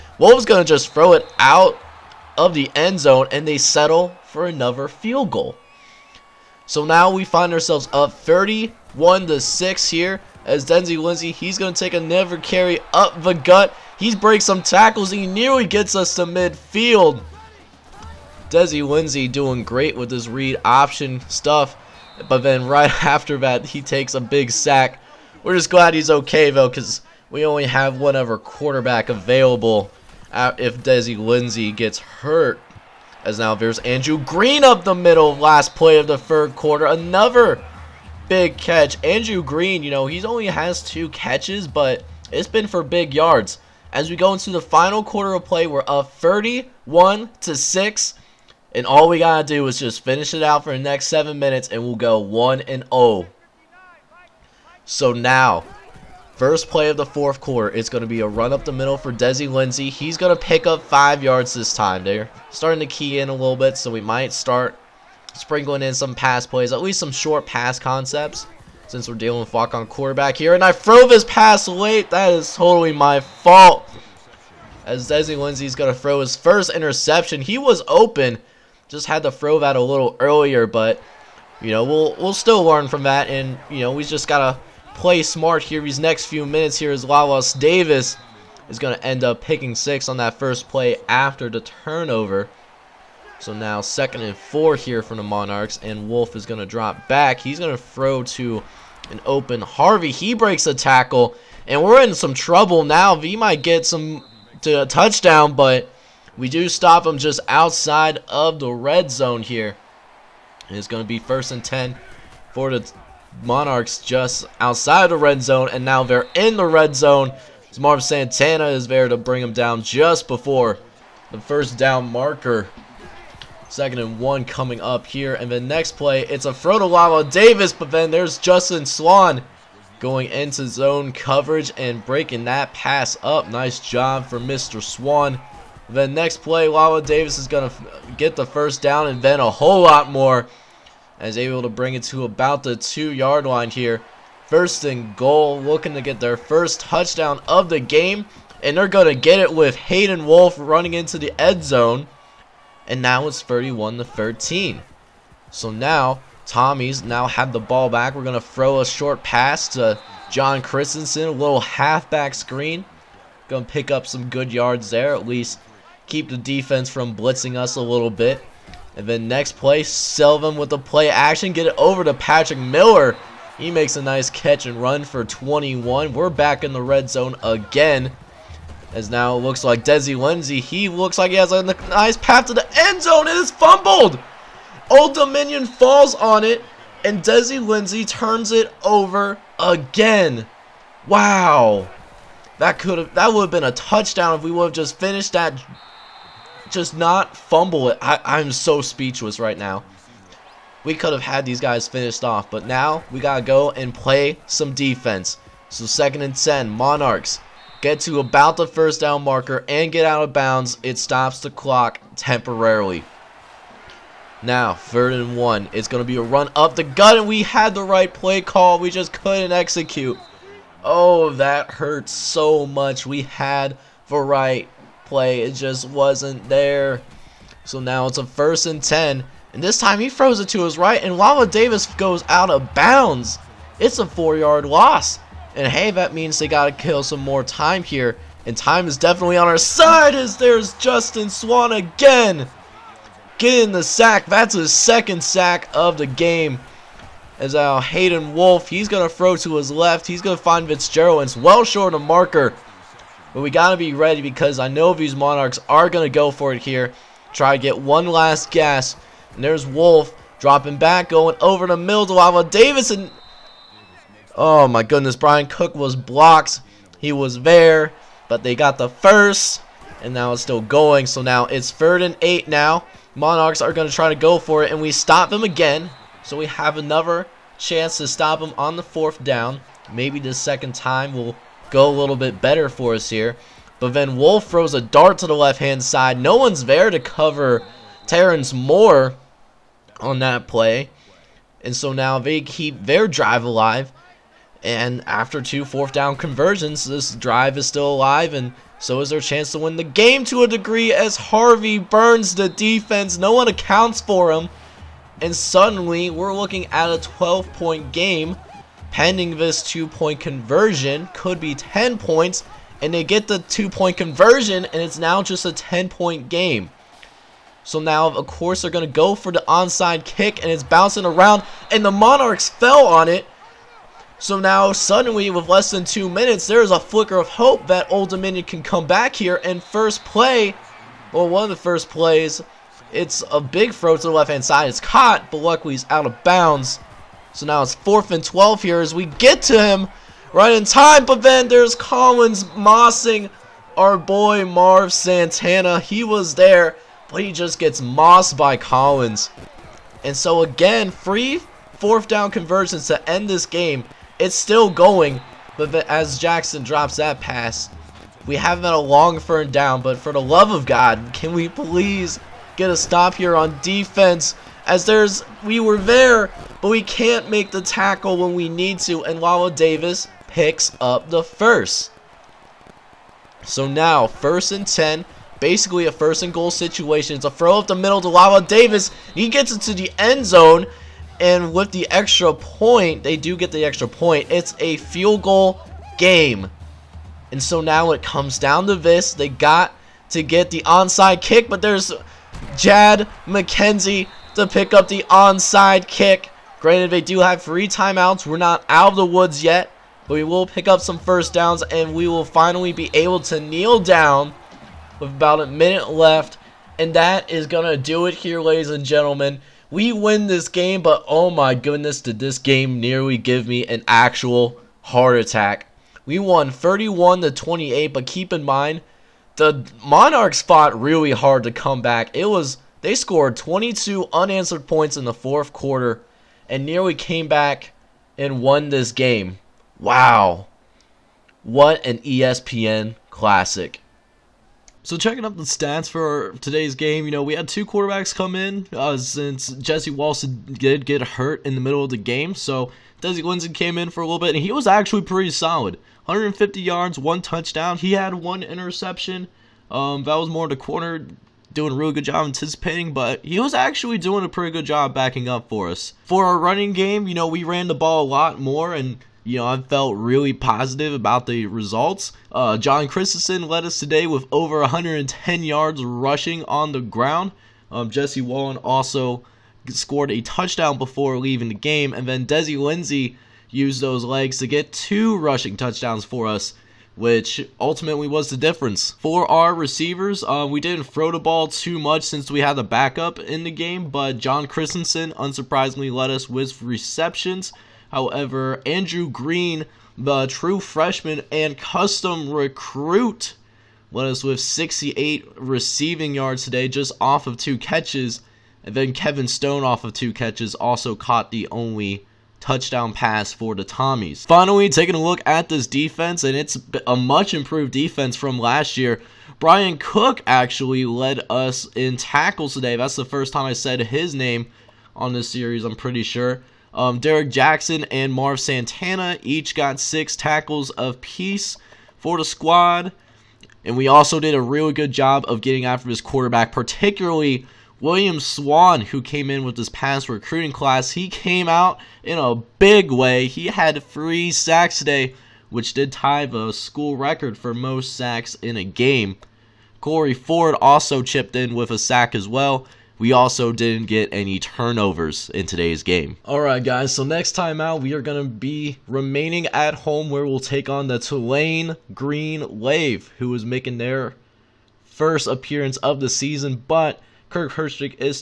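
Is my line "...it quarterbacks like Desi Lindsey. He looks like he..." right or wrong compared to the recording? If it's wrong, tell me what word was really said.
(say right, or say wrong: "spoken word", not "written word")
wrong: "looks", not "quarterbacks".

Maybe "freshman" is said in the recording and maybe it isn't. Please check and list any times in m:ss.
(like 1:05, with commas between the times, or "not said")
8:10.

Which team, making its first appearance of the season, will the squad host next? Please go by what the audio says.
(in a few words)
Tulane Green Wave.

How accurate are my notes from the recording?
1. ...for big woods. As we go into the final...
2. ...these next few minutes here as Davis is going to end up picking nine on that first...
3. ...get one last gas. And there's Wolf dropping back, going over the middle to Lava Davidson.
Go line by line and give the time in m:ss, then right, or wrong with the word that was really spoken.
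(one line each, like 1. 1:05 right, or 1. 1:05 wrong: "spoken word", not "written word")
1. 0:42 wrong: "yards", not "woods"
2. 1:25 wrong: "six", not "nine"
3. 4:17 right.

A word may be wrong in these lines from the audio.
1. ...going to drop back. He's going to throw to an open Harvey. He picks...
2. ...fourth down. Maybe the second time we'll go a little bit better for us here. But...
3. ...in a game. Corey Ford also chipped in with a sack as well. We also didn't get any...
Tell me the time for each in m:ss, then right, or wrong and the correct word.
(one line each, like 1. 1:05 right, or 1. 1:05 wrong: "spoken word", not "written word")
1. 1:36 wrong: "breaks", not "picks"
2. 4:38 right
3. 8:58 right.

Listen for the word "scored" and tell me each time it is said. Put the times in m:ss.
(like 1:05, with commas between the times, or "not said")
7:02, 7:49.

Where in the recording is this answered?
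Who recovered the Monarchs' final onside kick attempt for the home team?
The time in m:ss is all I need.
6:32.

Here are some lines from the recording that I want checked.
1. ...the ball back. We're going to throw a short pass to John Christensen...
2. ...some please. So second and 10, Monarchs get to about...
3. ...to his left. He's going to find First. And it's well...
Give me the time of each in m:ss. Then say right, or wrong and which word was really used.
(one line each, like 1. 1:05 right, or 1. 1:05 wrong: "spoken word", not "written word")
1. 2:37 right
2. 3:24 wrong: "defense", not "please"
3. 4:09 wrong: "Fitzgerald", not "First".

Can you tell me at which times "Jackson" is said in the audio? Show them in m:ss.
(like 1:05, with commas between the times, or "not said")
5:56, 8:37.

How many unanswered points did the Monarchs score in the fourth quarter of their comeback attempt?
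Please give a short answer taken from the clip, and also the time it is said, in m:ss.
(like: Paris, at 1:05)
22, at 7:03.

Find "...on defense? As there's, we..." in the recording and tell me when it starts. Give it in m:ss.
6:03.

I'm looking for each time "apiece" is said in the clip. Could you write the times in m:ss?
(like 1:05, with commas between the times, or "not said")
8:40.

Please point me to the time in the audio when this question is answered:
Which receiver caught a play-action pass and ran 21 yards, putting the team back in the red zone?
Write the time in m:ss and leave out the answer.
2:52.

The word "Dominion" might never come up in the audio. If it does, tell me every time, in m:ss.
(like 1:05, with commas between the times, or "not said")
3:05, 5:28.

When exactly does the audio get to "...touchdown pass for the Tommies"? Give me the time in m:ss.
8:22.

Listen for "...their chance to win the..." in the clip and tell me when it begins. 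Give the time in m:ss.
4:59.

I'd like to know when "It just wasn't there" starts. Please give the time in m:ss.
3:45.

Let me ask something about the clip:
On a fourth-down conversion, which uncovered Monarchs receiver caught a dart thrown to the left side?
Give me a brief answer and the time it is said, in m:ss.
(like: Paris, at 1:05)
Terrence Moore, at 4:48.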